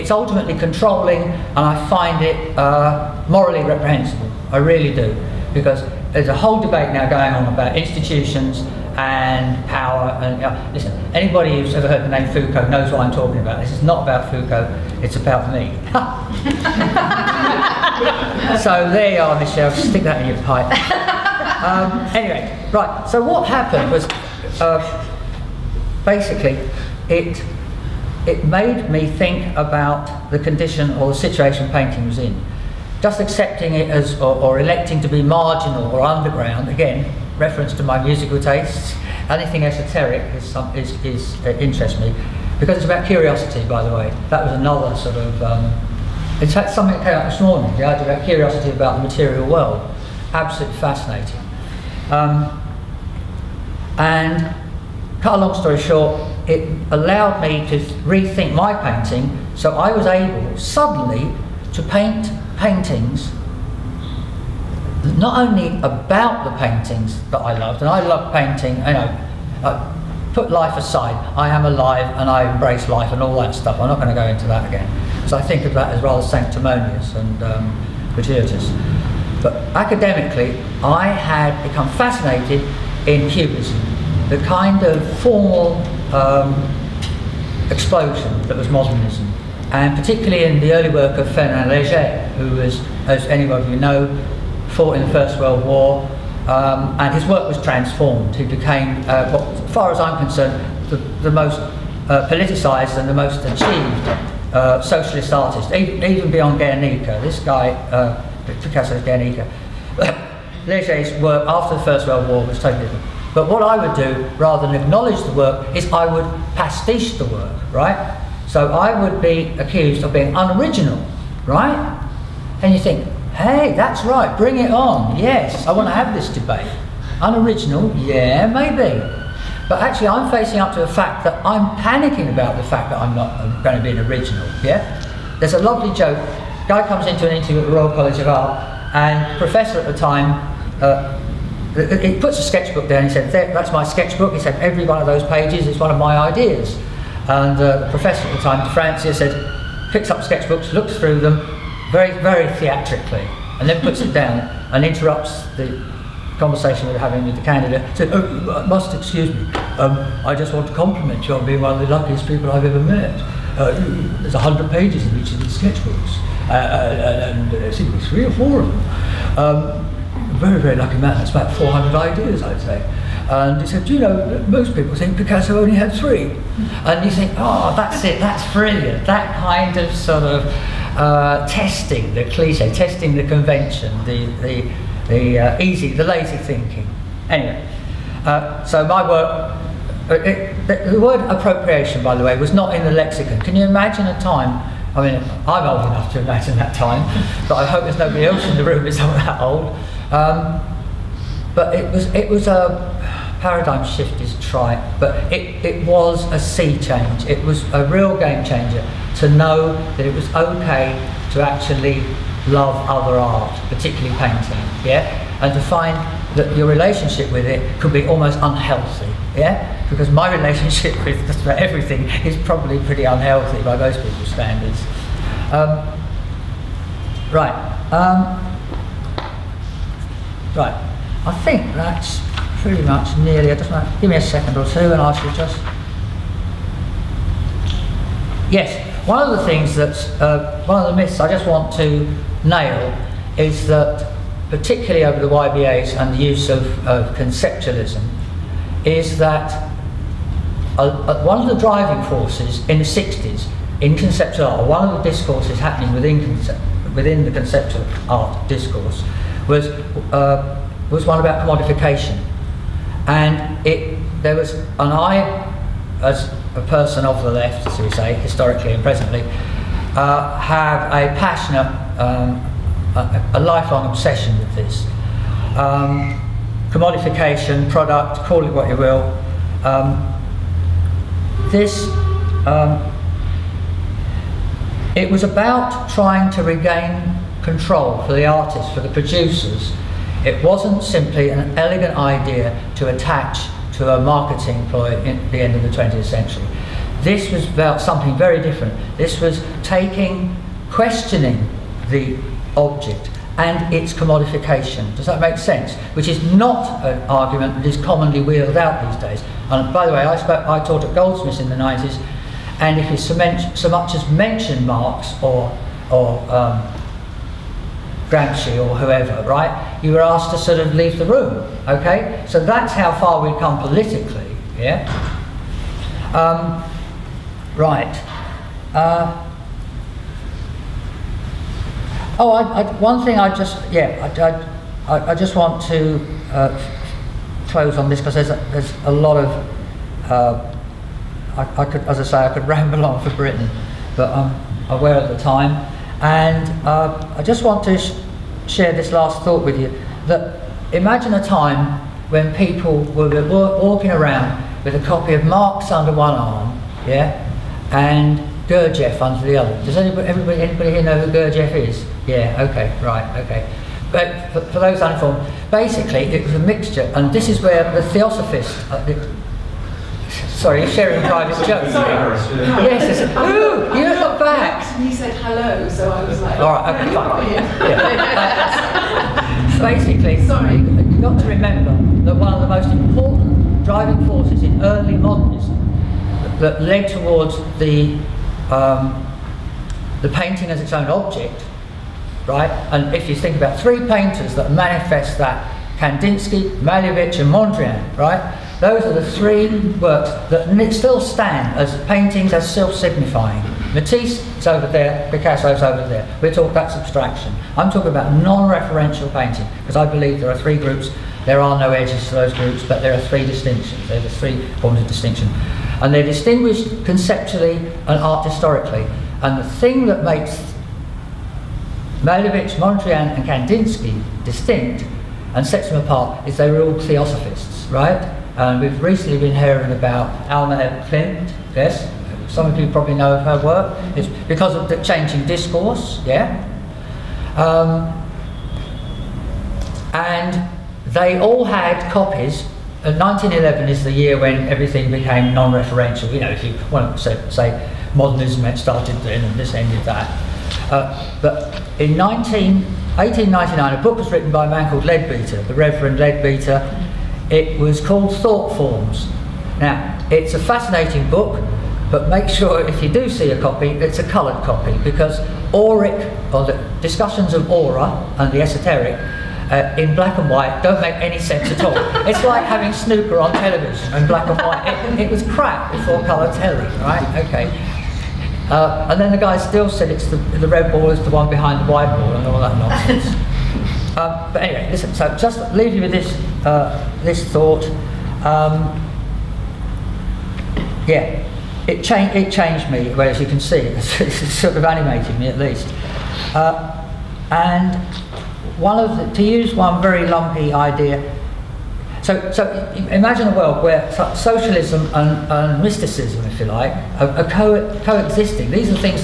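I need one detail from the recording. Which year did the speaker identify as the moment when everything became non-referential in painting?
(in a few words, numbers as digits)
1911.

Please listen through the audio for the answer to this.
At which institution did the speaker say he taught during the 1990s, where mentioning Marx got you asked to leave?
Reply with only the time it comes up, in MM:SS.
05:10.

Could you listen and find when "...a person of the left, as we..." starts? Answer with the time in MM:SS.
04:26.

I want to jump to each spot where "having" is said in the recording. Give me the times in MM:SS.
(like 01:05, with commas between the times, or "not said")
02:36, 07:52.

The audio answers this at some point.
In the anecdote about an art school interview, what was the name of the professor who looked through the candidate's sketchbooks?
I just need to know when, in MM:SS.
02:28.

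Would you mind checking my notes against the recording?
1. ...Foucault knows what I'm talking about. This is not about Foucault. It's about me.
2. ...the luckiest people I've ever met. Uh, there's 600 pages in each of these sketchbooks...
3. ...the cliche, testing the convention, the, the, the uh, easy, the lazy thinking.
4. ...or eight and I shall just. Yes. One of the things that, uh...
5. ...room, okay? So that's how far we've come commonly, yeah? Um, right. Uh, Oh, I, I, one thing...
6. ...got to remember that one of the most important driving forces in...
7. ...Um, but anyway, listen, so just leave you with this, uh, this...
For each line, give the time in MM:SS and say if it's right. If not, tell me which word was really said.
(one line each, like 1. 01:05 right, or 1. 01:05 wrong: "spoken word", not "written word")
1. 00:12 right
2. 02:41 wrong: "100", not "600"
3. 03:02 right
4. 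03:54 wrong: "two", not "eight"
5. 05:21 wrong: "politically", not "commonly"
6. 06:21 right
7. 08:03 right.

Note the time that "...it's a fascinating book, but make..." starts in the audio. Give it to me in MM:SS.
07:40.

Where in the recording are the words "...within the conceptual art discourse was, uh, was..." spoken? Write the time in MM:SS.
04:16.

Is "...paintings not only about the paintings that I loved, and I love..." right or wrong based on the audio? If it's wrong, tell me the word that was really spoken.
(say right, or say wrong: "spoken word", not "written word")
right.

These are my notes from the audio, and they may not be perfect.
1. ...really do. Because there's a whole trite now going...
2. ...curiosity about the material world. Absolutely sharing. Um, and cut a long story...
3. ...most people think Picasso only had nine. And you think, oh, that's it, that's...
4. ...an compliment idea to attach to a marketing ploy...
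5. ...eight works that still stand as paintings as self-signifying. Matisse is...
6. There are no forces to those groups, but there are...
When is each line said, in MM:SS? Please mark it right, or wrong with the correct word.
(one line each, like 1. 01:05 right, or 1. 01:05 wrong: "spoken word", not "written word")
1. 00:04 wrong: "debate", not "trite"
2. 00:48 wrong: "fascinating", not "sharing"
3. 02:54 wrong: "three", not "nine"
4. 04:51 wrong: "elegant", not "compliment"
5. 06:39 wrong: "three", not "eight"
6. 06:51 wrong: "edges", not "forces".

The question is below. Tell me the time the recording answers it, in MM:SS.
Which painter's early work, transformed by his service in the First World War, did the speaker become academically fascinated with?
01:31.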